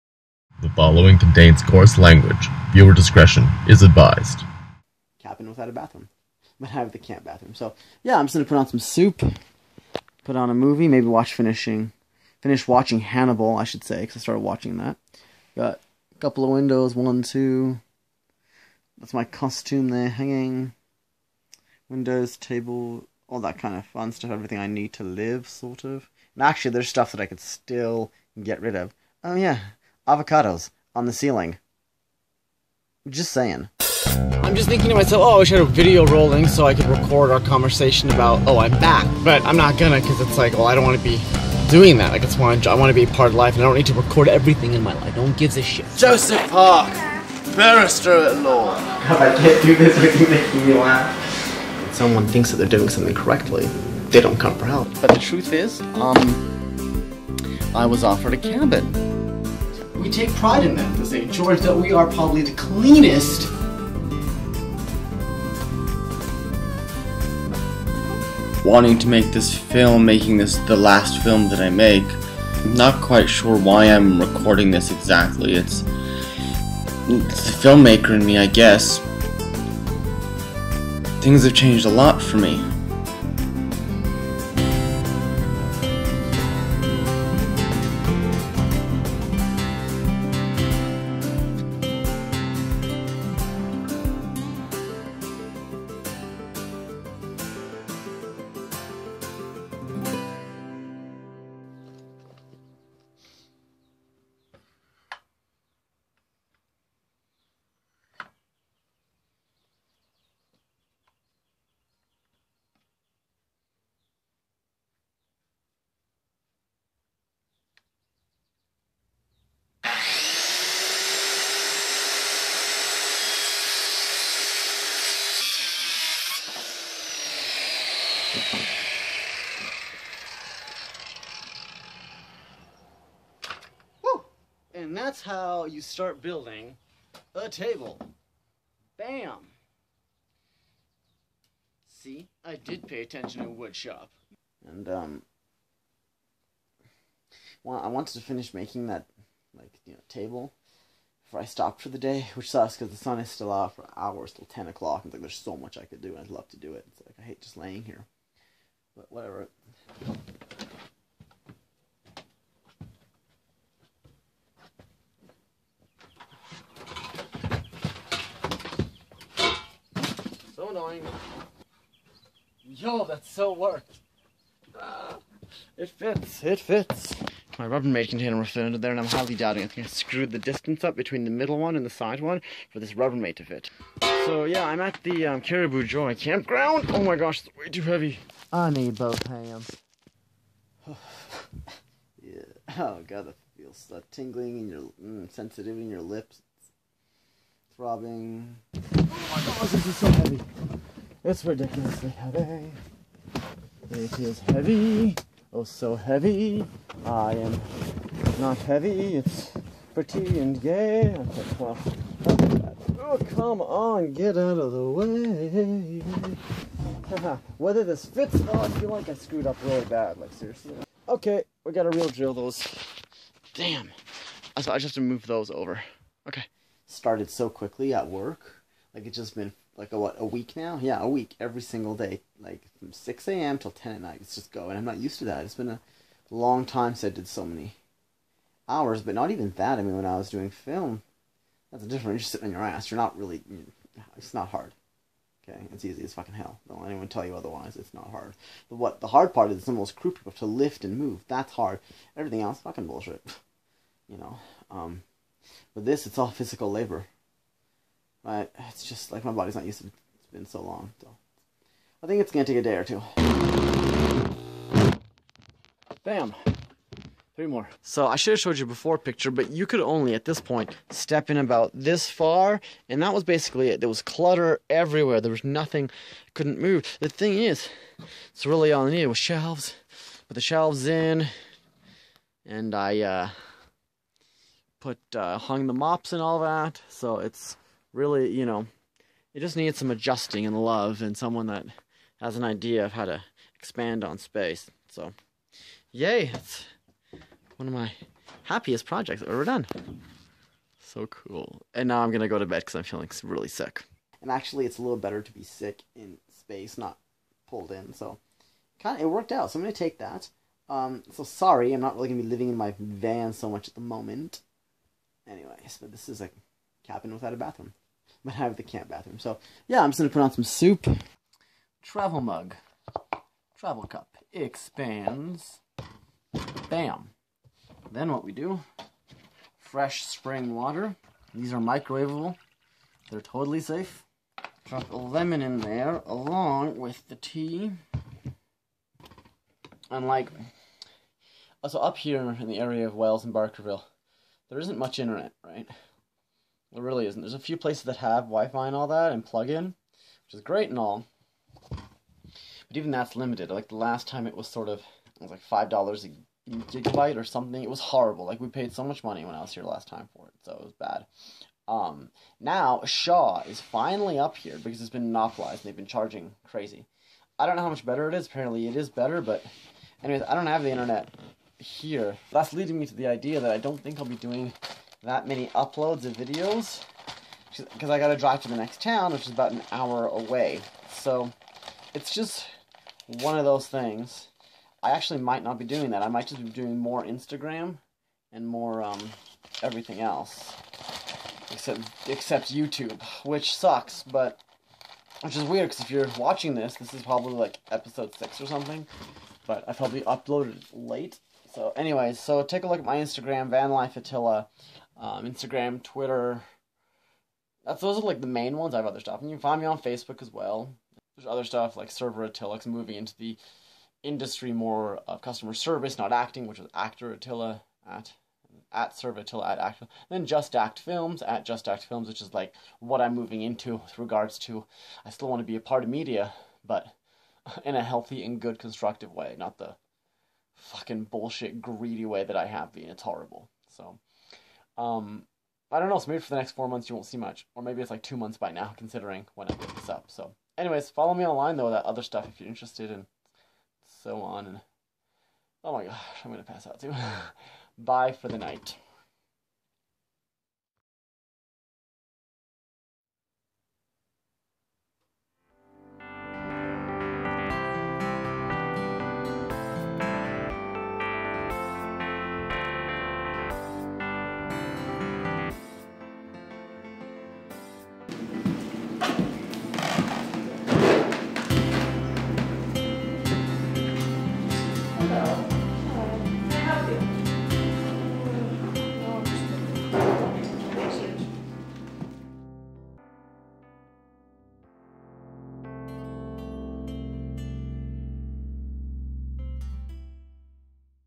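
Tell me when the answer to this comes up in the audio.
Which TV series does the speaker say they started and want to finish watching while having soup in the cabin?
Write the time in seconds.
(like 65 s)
13 s.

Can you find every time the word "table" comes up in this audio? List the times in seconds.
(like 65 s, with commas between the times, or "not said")
22 s, 137 s, 150 s.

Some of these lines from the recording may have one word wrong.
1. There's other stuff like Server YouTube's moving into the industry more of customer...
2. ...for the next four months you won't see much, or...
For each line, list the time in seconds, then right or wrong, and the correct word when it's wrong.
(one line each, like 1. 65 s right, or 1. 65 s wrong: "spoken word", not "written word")
1. 411 s wrong: "Attila", not "YouTube"
2. 436 s right.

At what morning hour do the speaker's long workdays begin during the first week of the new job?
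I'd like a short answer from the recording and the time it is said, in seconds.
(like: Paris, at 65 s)
6 a.m., at 232 s.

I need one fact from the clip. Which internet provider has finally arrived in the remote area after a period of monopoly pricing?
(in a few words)
Shaw.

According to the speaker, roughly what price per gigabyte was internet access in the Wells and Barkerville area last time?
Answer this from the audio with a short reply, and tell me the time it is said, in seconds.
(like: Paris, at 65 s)
$5, at 355 s.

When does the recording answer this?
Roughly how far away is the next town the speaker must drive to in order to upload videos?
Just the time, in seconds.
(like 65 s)
379 s.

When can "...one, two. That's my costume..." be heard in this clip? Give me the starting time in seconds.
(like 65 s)
16 s.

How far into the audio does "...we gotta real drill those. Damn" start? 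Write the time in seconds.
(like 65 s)
221 s.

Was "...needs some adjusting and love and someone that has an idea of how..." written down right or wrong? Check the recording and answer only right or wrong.
right.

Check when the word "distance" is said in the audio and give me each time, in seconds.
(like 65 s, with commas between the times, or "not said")
180 s.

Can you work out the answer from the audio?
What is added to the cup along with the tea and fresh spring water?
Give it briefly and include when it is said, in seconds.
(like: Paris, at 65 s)
A lemon, at 334 s.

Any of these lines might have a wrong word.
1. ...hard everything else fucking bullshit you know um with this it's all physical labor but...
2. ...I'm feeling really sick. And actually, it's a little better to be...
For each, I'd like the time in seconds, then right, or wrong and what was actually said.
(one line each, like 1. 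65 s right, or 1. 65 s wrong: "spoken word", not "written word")
1. 251 s right
2. 302 s right.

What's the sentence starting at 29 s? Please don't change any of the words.
Oh, yeah avocados on the ceiling.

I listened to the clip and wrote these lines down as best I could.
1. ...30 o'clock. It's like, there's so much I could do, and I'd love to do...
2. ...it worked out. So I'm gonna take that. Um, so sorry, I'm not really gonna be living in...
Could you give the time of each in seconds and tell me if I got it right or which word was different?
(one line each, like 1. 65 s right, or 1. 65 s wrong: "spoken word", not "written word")
1. 154 s wrong: "10", not "30"
2. 309 s right.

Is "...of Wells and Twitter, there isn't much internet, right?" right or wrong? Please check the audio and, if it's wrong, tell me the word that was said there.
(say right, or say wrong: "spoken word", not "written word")
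wrong: "Barkerville", not "Twitter".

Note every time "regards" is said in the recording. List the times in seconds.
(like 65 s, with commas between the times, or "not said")
423 s.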